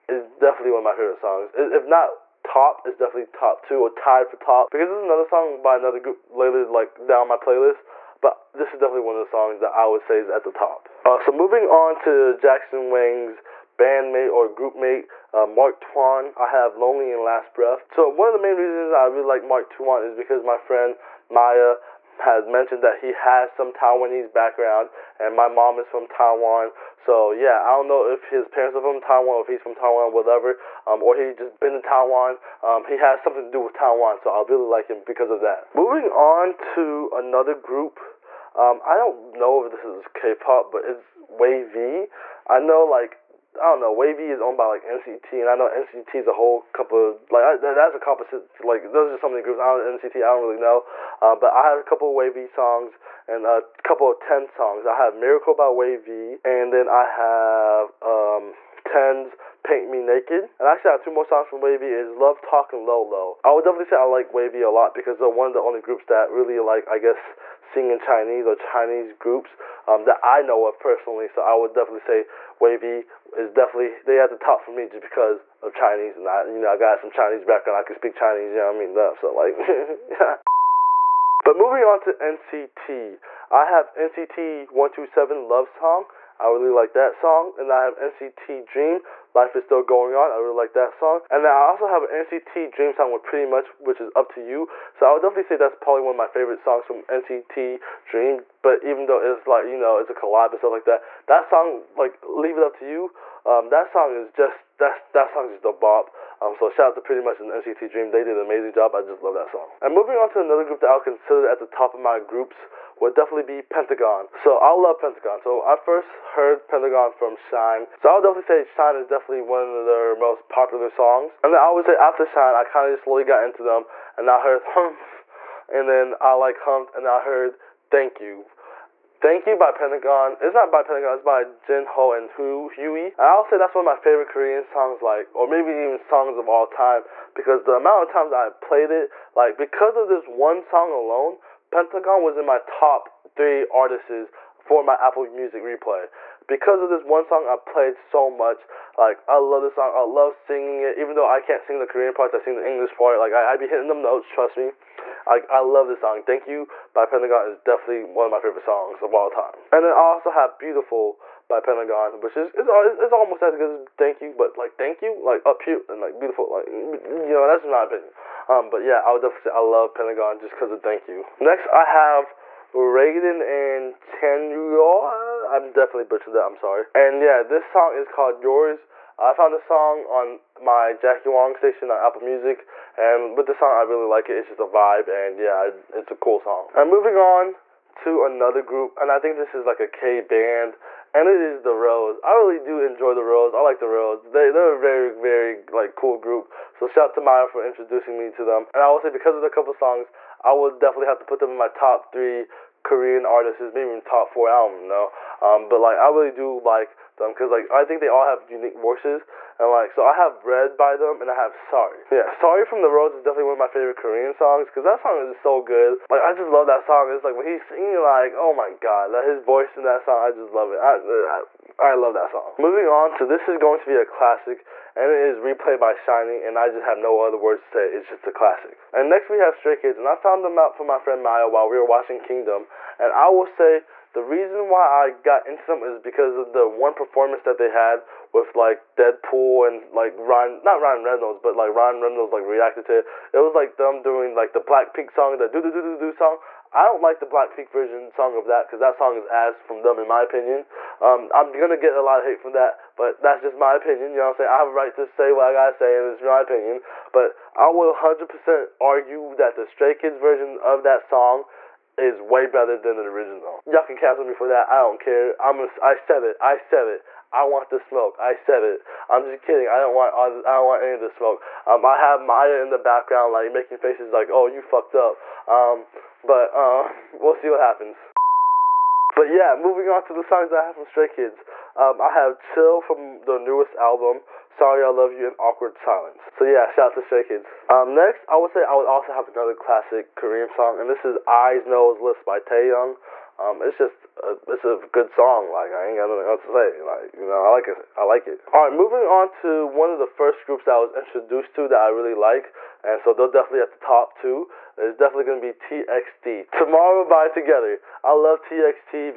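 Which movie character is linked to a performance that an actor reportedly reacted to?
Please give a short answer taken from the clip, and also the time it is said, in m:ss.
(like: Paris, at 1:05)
Deadpool, at 3:58.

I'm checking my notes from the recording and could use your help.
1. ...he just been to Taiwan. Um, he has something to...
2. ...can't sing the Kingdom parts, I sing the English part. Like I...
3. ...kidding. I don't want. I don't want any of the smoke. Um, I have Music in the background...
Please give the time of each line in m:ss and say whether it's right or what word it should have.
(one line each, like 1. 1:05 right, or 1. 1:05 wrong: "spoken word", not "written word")
1. 0:31 right
2. 2:31 wrong: "Korean", not "Kingdom"
3. 4:29 wrong: "Maya", not "Music".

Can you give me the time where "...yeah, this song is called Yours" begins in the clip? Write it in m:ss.
2:57.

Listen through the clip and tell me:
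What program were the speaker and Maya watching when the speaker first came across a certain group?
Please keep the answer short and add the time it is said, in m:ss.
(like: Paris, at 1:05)
Kingdom, at 3:52.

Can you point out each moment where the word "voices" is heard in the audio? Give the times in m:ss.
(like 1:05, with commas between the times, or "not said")
3:28, 3:39.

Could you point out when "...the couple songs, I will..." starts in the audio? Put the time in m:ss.
3:19.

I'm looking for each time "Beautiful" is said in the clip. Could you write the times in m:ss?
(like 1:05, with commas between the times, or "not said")
2:40, 2:46.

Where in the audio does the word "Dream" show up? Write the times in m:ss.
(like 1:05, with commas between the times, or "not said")
1:28, 1:32, 1:38, 1:47.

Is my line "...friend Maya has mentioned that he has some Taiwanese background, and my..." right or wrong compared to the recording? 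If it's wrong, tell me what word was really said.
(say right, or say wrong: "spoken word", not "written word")
right.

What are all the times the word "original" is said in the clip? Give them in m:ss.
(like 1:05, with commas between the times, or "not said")
4:23.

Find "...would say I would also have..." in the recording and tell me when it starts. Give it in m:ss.
4:48.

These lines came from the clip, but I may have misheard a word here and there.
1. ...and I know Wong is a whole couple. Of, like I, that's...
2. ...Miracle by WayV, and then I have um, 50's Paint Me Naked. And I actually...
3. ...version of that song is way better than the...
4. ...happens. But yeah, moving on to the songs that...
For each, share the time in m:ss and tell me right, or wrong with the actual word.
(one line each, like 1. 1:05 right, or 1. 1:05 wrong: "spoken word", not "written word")
1. 0:45 wrong: "NCT", not "Wong"
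2. 0:55 wrong: "10", not "50"
3. 4:20 right
4. 4:37 right.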